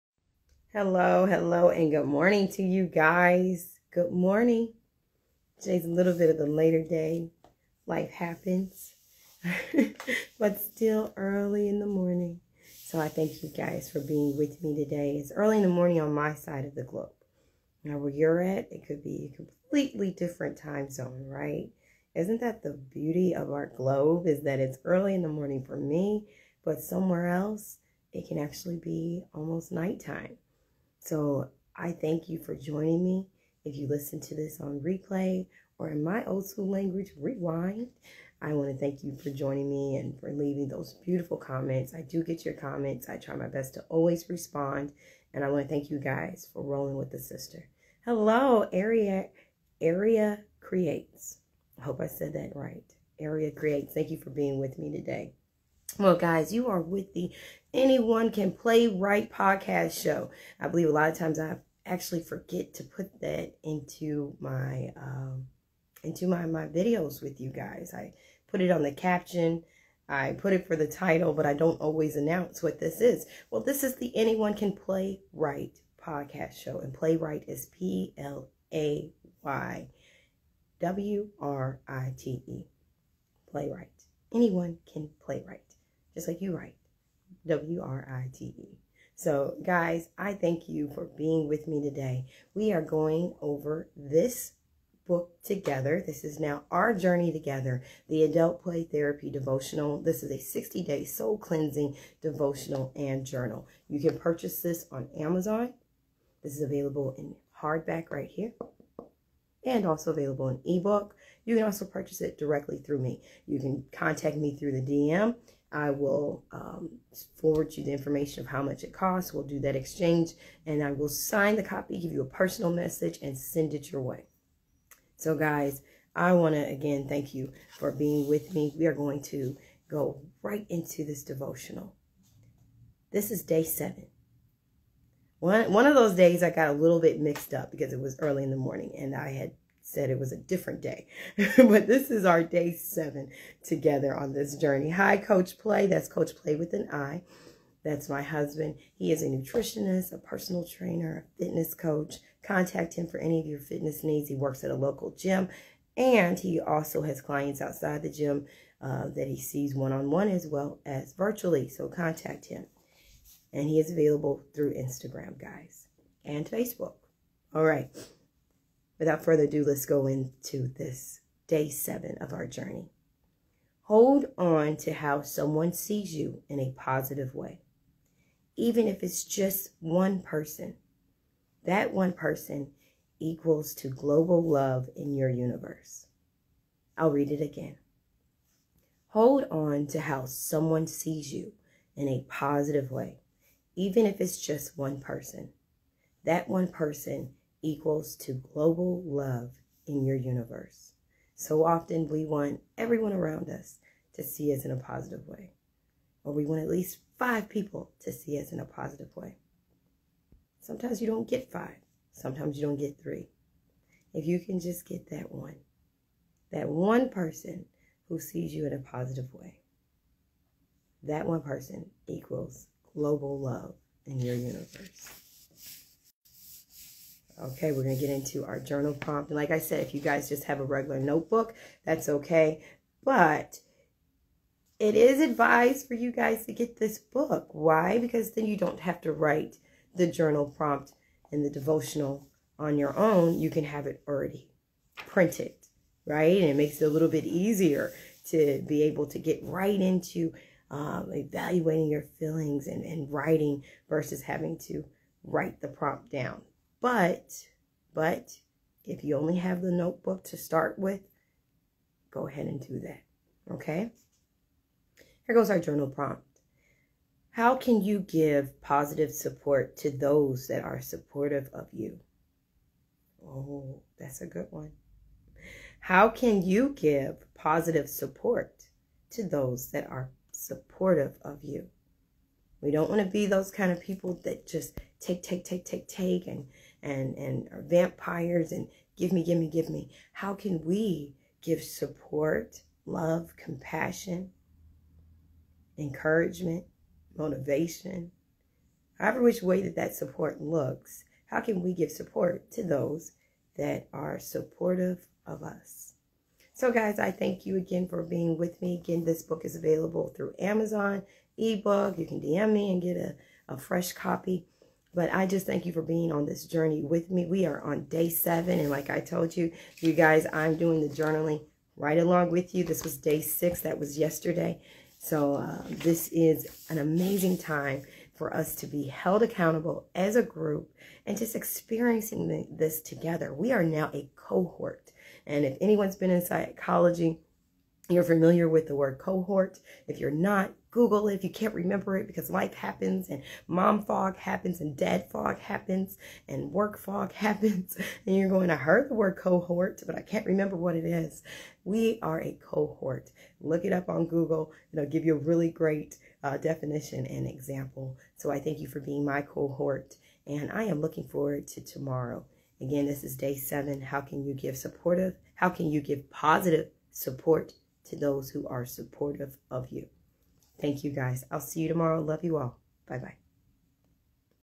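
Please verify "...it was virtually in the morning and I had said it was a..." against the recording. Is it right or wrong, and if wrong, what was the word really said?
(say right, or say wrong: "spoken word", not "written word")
wrong: "early", not "virtually".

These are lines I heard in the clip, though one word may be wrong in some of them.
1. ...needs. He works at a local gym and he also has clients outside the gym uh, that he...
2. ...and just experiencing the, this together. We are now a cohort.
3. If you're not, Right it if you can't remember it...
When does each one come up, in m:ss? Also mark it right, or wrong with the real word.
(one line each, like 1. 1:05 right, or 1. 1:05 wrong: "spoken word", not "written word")
1. 2:34 right
2. 5:31 right
3. 5:39 wrong: "Google", not "Right".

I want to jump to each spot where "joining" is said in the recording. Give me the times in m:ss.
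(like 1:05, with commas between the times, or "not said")
0:32, 0:39.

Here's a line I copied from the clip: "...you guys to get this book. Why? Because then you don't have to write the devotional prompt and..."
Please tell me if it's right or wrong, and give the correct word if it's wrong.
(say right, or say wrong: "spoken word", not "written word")
wrong: "journal", not "devotional".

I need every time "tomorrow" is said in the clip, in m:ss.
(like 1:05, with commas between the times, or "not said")
6:01, 6:11.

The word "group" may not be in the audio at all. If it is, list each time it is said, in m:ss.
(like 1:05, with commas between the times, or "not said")
5:30.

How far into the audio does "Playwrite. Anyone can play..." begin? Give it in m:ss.
1:23.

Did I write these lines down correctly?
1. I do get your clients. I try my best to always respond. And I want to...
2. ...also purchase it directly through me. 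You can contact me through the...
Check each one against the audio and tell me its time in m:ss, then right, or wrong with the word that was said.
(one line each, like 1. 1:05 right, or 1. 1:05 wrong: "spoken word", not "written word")
1. 0:41 wrong: "comments", not "clients"
2. 1:51 right.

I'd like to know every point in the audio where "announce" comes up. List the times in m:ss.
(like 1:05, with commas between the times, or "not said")
1:12.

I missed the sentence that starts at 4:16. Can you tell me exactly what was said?
But, but if you only have the notebook to start with, go ahead and do that.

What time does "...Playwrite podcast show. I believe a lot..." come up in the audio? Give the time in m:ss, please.
0:58.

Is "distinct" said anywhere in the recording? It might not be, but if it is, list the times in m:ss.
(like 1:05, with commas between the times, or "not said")
not said.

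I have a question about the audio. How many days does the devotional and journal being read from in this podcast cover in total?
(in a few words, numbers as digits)
60.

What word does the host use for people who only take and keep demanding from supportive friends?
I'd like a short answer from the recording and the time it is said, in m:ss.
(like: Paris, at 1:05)
vampires, at 4:47.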